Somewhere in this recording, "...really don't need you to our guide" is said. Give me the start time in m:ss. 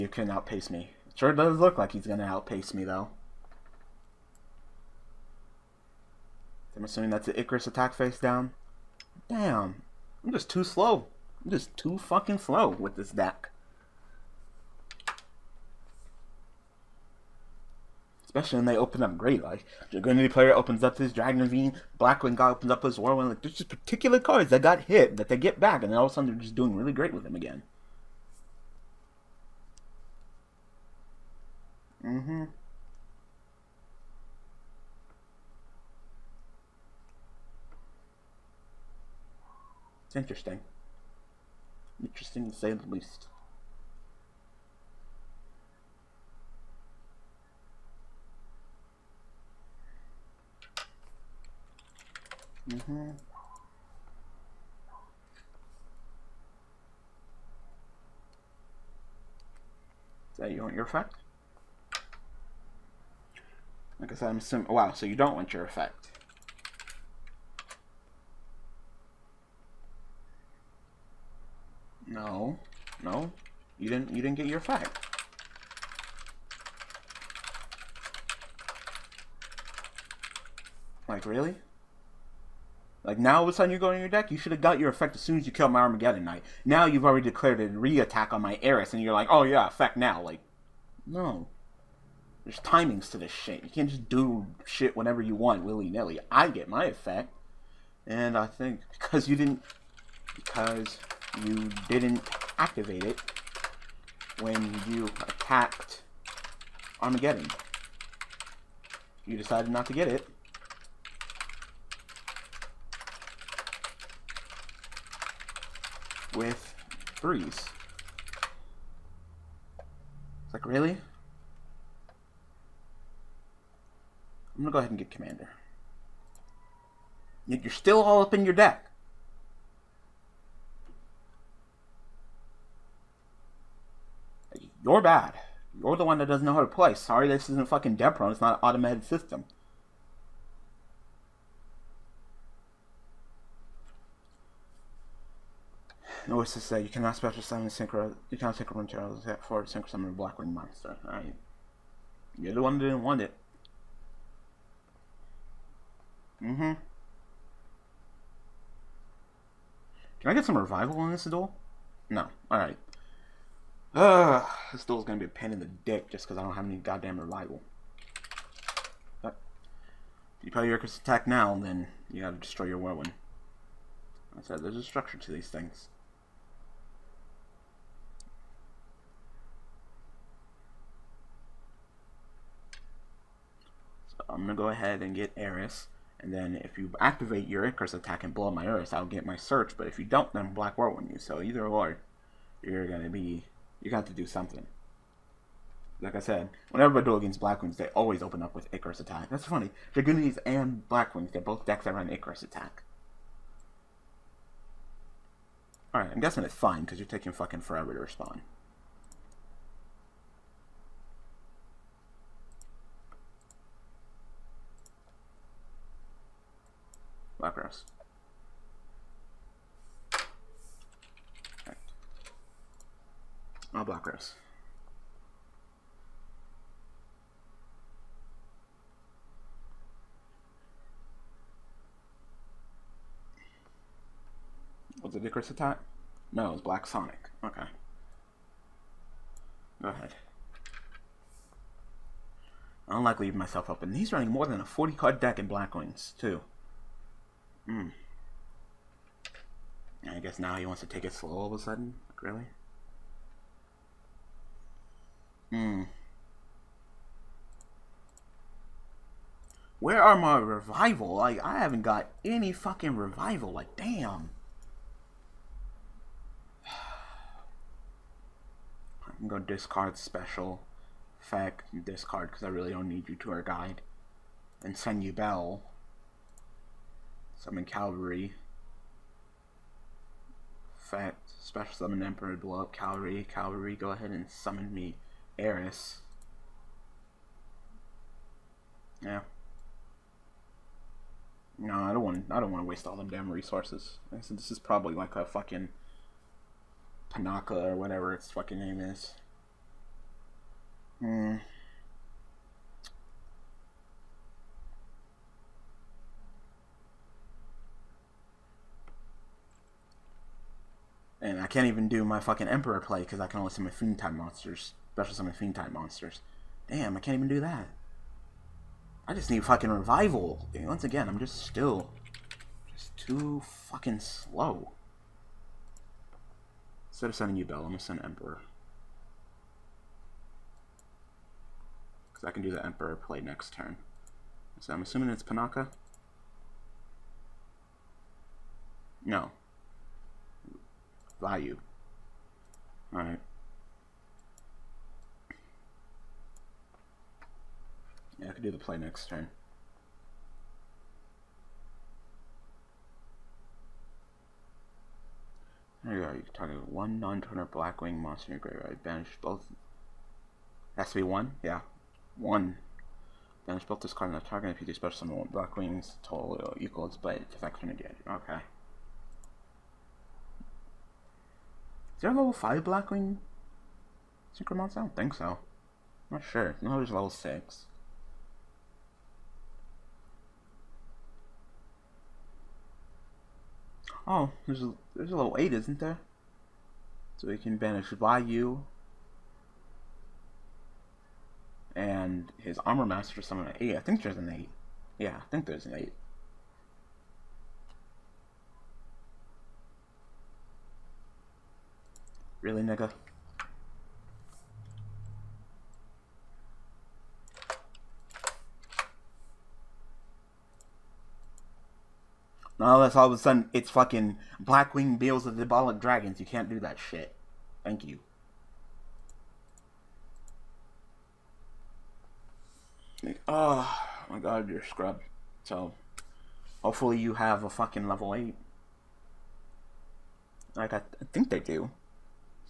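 4:32.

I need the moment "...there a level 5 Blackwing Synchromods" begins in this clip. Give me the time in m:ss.
6:12.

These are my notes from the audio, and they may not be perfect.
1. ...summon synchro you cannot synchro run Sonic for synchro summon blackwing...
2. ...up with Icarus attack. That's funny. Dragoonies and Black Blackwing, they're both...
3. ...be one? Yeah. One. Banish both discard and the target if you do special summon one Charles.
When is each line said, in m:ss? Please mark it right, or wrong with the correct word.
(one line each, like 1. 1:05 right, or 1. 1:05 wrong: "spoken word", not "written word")
1. 2:27 wrong: "Charles", not "Sonic"
2. 3:18 wrong: "Wings", not "Blackwing"
3. 6:00 wrong: "Blackwings", not "Charles".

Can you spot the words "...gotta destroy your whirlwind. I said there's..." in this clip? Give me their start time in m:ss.
2:52.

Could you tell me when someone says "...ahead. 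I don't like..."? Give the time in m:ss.
3:59.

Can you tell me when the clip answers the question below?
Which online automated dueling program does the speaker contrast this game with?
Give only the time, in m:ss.
2:17.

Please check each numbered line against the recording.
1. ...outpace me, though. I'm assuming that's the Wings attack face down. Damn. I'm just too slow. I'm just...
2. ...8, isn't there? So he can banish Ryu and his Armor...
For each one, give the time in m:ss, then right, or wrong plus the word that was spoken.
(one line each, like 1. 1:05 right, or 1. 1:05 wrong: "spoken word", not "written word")
1. 0:02 wrong: "Icarus", not "Wings"
2. 6:25 right.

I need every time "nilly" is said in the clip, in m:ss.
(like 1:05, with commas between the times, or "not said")
1:35.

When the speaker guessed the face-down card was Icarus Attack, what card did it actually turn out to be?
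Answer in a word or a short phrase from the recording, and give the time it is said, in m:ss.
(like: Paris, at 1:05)
Black Sonic, at 3:56.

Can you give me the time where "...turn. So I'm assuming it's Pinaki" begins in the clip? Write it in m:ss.
5:33.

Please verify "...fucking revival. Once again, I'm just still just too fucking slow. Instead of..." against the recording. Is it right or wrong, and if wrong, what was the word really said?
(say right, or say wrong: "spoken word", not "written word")
right.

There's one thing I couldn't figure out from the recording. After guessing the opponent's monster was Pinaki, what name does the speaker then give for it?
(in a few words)
Vayu.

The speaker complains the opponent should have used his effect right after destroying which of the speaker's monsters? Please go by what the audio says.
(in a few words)
Armageddon Knight.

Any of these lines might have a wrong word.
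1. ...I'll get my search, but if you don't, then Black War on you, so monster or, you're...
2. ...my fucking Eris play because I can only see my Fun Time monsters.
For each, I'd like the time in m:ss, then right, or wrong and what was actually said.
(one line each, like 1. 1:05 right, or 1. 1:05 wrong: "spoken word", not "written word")
1. 3:08 wrong: "either", not "monster"
2. 5:12 wrong: "Emperor", not "Eris".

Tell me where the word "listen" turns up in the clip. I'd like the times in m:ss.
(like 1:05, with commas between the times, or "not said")
not said.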